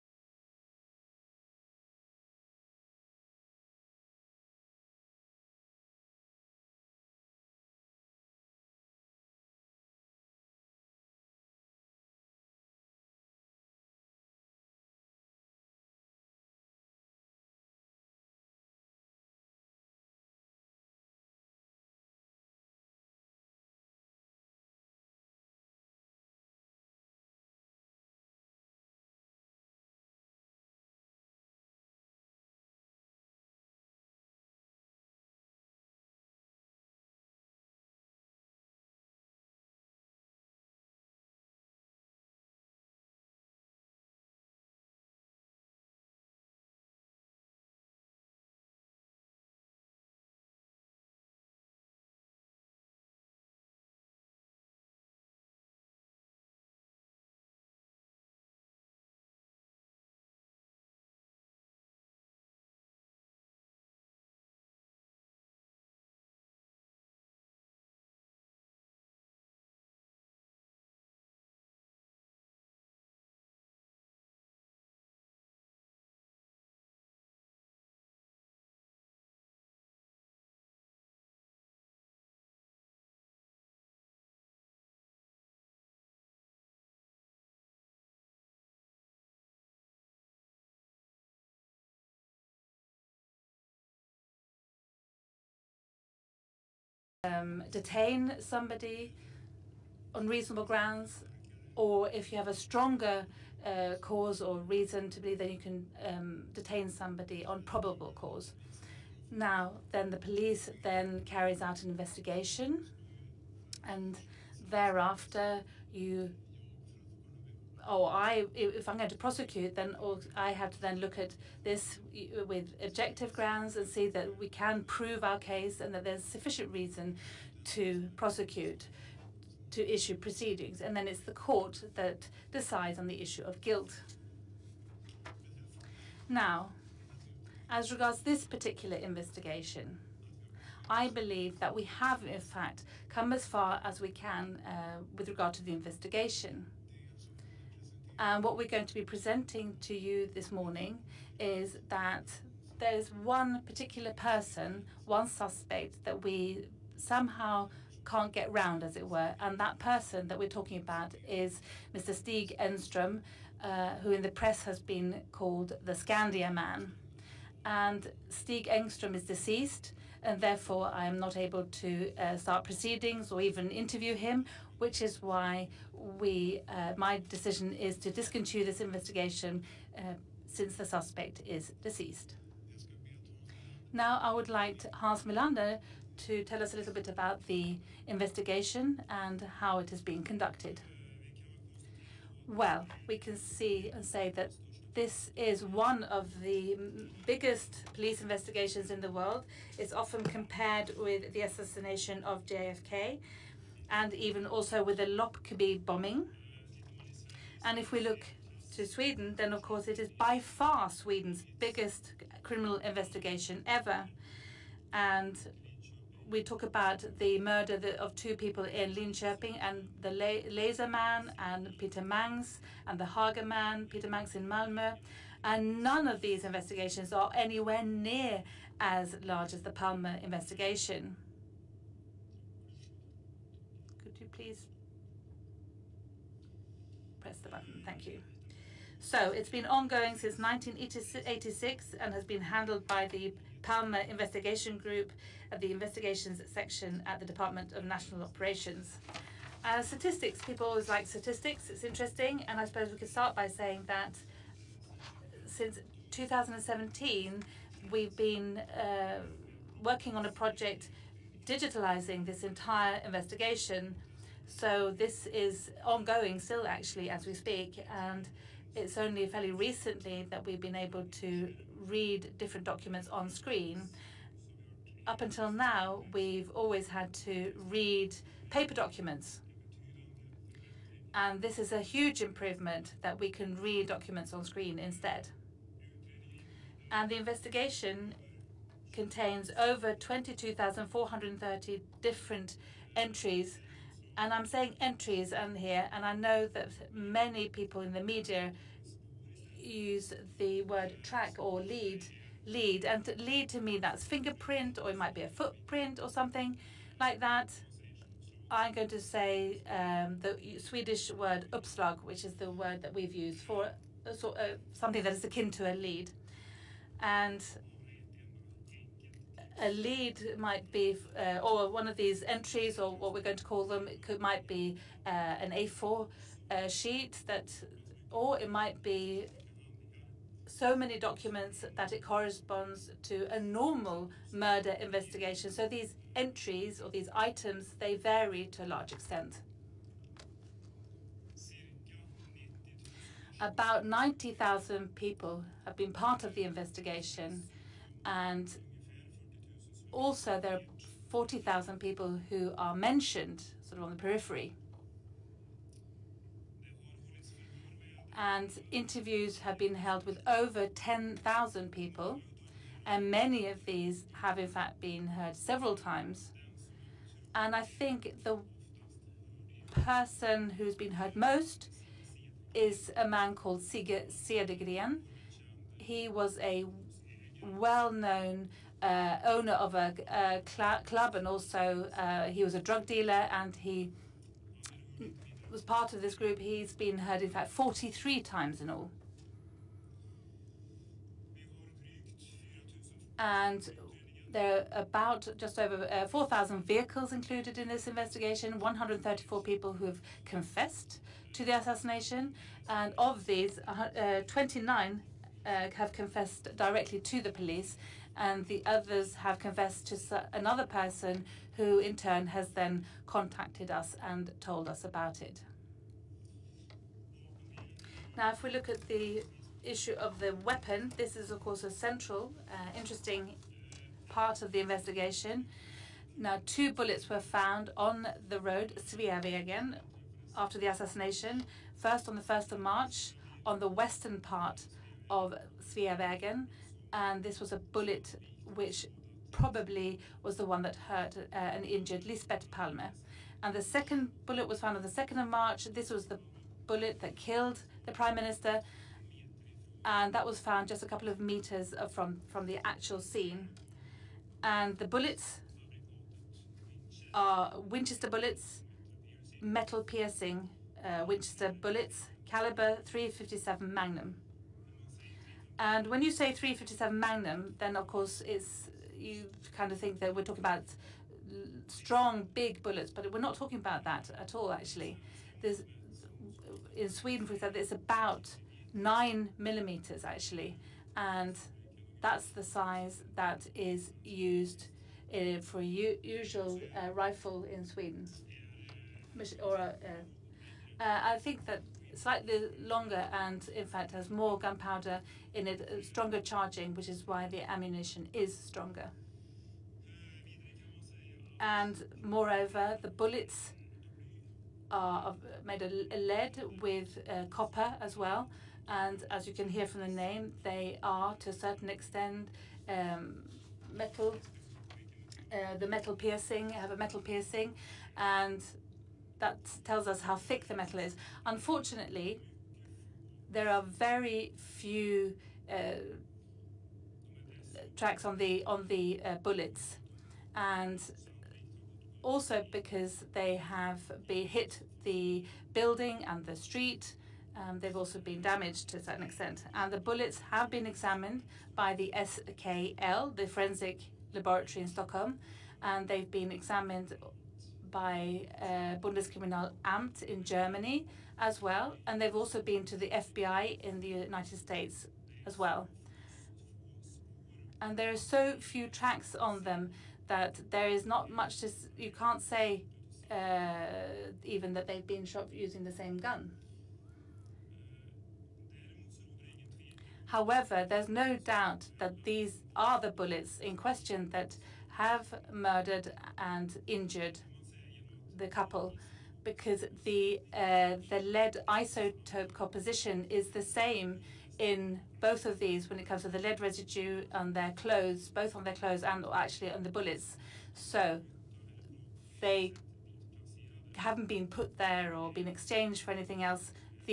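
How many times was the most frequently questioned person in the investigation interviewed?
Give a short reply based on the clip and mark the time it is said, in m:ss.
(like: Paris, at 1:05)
43, at 6:27.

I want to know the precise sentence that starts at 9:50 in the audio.
So they haven't been put there or been exchanged for anything else.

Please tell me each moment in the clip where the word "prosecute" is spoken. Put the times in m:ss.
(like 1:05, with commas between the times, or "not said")
1:59, 2:08.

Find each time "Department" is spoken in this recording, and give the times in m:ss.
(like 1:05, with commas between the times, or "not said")
4:07.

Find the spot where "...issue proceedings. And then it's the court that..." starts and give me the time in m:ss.
2:09.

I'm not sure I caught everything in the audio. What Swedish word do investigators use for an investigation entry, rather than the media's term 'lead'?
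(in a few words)
upslag.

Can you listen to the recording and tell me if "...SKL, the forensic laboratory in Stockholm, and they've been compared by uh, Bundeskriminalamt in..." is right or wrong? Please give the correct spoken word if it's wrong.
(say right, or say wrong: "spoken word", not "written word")
wrong: "examined", not "compared".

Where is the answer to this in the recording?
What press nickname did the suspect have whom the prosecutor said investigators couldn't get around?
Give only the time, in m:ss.
2:45.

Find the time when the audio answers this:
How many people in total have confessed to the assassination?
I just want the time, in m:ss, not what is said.
6:38.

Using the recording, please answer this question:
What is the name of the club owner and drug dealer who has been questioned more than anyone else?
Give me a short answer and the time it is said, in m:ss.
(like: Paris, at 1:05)
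Sigurd Cedergren, at 6:13.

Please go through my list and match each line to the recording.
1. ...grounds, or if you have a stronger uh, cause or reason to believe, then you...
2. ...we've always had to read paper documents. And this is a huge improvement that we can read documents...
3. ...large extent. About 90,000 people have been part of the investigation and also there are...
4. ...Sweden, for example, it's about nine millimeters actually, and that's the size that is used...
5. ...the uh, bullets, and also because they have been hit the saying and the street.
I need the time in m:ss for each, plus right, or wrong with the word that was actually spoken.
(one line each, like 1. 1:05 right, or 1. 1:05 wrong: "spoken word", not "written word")
1. 1:40 right
2. 4:36 right
3. 5:38 right
4. 7:56 right
5. 8:48 wrong: "building", not "saying".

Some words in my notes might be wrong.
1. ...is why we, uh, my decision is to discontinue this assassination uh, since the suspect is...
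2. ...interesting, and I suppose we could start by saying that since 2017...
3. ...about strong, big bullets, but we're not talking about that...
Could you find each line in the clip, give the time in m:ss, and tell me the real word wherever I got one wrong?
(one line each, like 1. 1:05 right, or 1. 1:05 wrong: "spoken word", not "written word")
1. 2:55 wrong: "investigation", not "assassination"
2. 4:11 right
3. 7:50 right.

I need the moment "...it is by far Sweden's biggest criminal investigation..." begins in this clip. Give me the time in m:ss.
3:29.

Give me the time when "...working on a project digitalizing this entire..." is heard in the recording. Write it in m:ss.
4:19.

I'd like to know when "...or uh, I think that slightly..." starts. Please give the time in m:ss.
8:09.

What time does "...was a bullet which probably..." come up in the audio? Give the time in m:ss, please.
7:17.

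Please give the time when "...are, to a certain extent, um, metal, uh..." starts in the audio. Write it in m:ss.
8:30.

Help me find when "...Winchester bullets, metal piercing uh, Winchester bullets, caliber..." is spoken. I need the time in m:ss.
7:37.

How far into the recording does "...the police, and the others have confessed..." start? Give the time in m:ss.
6:47.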